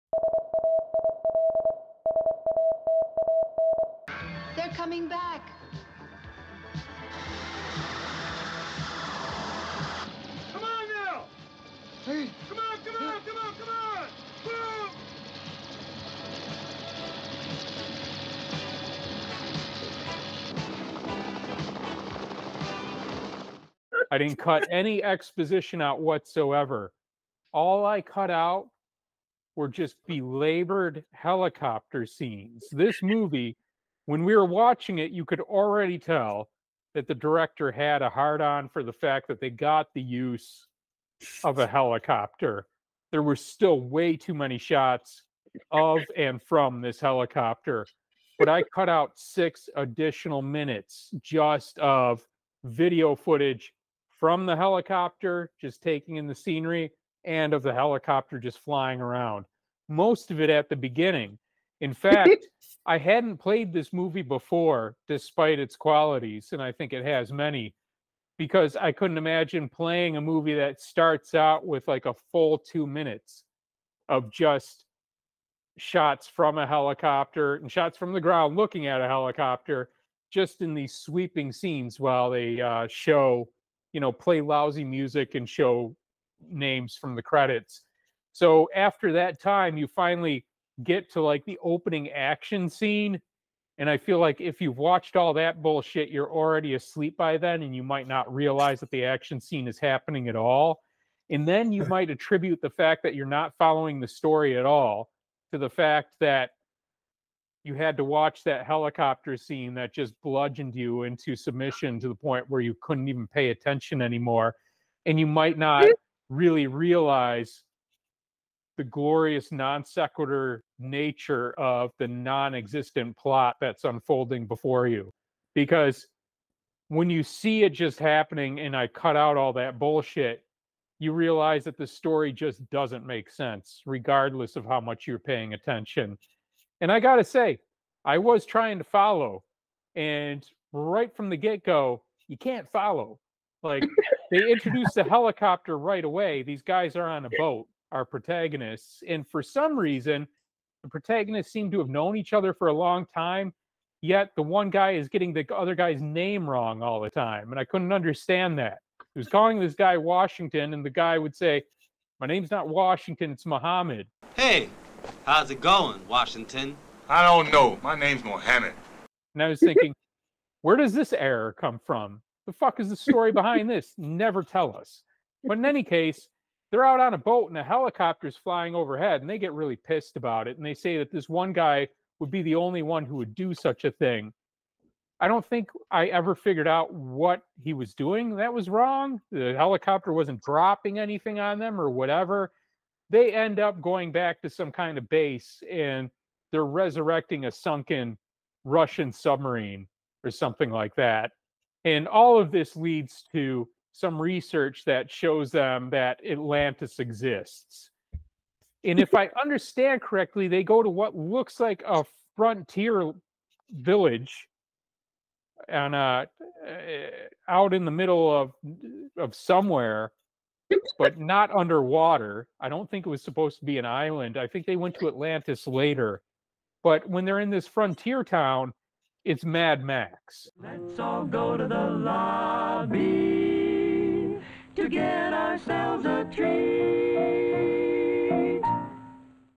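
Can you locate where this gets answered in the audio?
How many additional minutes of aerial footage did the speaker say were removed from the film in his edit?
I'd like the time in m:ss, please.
0:49.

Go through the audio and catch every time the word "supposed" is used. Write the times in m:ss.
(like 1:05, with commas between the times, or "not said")
3:43.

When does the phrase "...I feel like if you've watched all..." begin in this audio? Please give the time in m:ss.
1:33.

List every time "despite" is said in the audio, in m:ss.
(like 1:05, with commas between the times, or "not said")
1:05.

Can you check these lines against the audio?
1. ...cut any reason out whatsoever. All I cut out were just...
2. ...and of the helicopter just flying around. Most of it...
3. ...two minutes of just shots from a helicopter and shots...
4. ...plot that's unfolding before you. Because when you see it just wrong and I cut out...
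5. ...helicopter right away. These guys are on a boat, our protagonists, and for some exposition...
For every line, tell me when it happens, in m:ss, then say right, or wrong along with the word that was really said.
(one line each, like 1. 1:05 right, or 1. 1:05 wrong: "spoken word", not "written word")
1. 0:24 wrong: "exposition", not "reason"
2. 0:57 right
3. 1:12 right
4. 2:03 wrong: "happening", not "wrong"
5. 2:25 wrong: "reason", not "exposition".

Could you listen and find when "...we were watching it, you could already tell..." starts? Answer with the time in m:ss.
0:34.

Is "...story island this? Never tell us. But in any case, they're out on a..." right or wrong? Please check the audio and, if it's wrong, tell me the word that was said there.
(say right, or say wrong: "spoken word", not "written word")
wrong: "behind", not "island".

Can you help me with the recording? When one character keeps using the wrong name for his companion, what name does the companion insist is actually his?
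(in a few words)
Muhammad.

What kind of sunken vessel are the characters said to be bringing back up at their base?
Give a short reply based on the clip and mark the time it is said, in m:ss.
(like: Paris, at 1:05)
Russian submarine, at 3:18.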